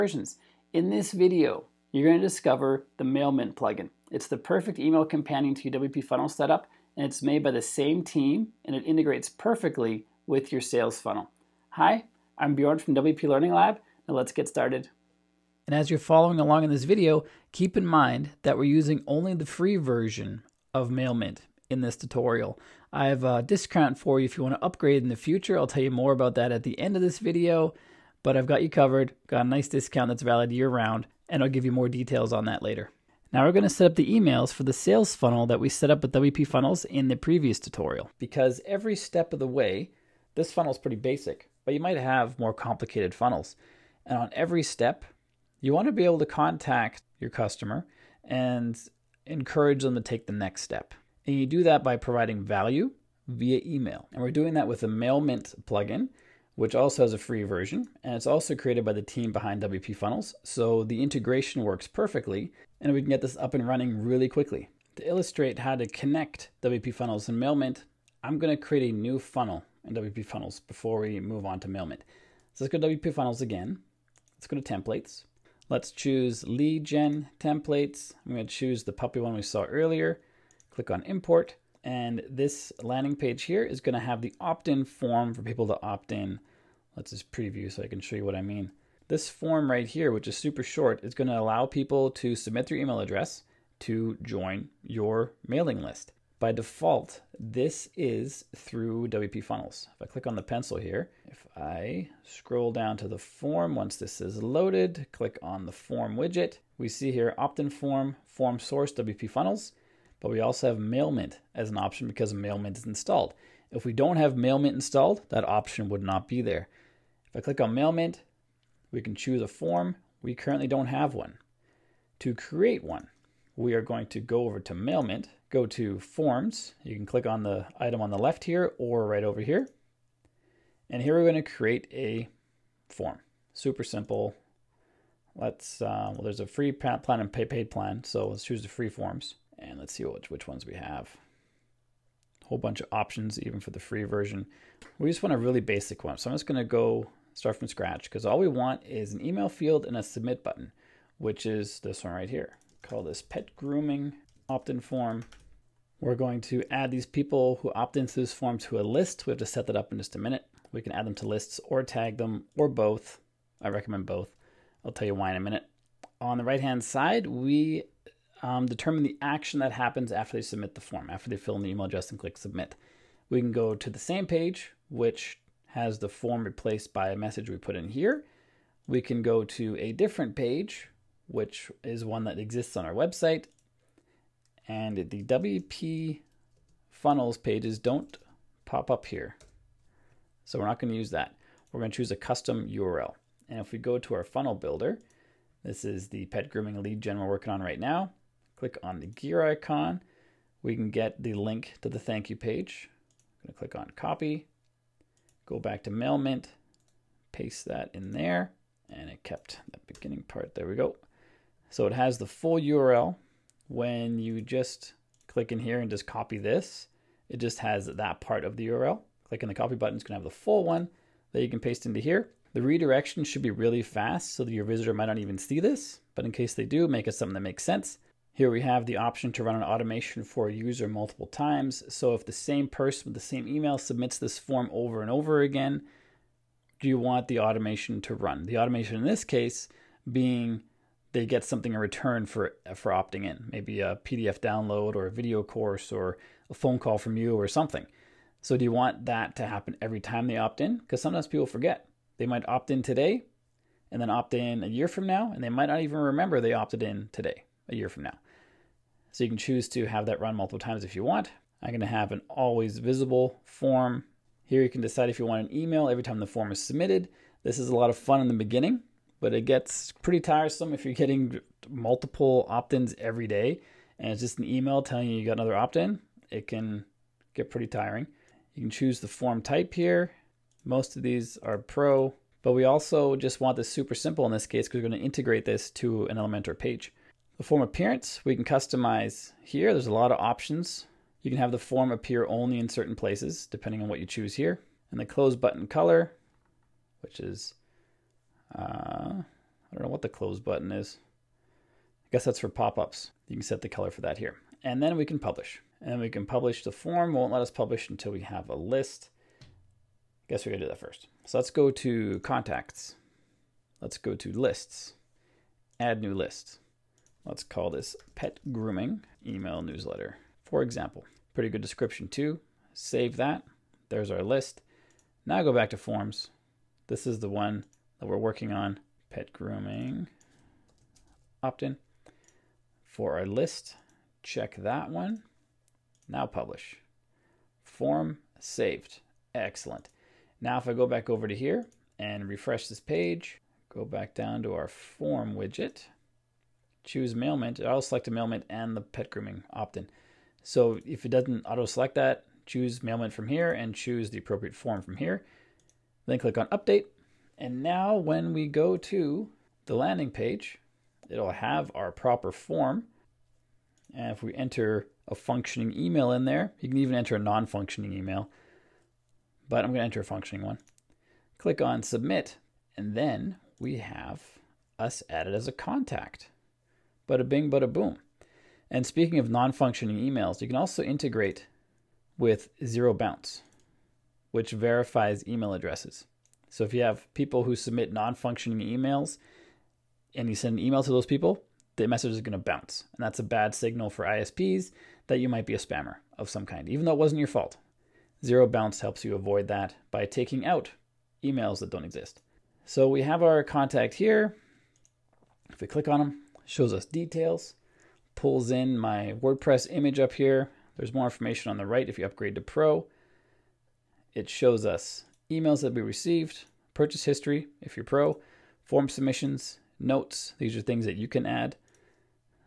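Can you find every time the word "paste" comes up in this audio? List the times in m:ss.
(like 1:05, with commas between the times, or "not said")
3:27, 3:41.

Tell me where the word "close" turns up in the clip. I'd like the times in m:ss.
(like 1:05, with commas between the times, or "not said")
4:55, 5:00.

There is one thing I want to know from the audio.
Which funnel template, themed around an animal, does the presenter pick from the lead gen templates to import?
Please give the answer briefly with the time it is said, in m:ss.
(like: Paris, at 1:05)
the puppy one, at 1:18.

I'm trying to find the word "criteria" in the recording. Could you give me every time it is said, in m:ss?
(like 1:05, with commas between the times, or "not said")
not said.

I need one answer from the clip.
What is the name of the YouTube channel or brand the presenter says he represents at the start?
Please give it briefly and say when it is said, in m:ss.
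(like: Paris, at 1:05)
WP Learning Lab, at 0:12.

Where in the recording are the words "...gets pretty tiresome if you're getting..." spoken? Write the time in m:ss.
4:29.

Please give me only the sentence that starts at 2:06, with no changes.
You can click on the item on the left here or right over here.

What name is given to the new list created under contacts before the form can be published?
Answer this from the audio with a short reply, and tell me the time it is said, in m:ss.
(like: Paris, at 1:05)
pet grooming email newsletter, at 5:18.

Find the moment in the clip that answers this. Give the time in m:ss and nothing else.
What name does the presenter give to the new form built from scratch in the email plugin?
2:33.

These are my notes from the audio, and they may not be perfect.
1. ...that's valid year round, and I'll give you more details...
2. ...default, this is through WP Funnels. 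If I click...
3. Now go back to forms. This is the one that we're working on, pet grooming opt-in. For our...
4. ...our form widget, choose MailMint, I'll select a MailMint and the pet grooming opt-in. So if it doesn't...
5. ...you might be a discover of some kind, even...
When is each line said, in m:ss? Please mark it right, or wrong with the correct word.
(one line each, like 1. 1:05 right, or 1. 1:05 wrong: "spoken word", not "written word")
1. 0:30 right
2. 1:36 right
3. 5:25 right
4. 5:44 right
5. 6:35 wrong: "spammer", not "discover".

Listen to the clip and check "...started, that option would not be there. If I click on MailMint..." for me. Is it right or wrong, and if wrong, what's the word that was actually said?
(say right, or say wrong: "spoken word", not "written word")
wrong: "installed", not "started".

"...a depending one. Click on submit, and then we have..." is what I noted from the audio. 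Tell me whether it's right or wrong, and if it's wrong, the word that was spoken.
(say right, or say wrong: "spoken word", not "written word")
wrong: "functioning", not "depending".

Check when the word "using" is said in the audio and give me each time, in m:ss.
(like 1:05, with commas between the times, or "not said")
0:18.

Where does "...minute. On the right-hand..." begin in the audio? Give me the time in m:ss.
2:45.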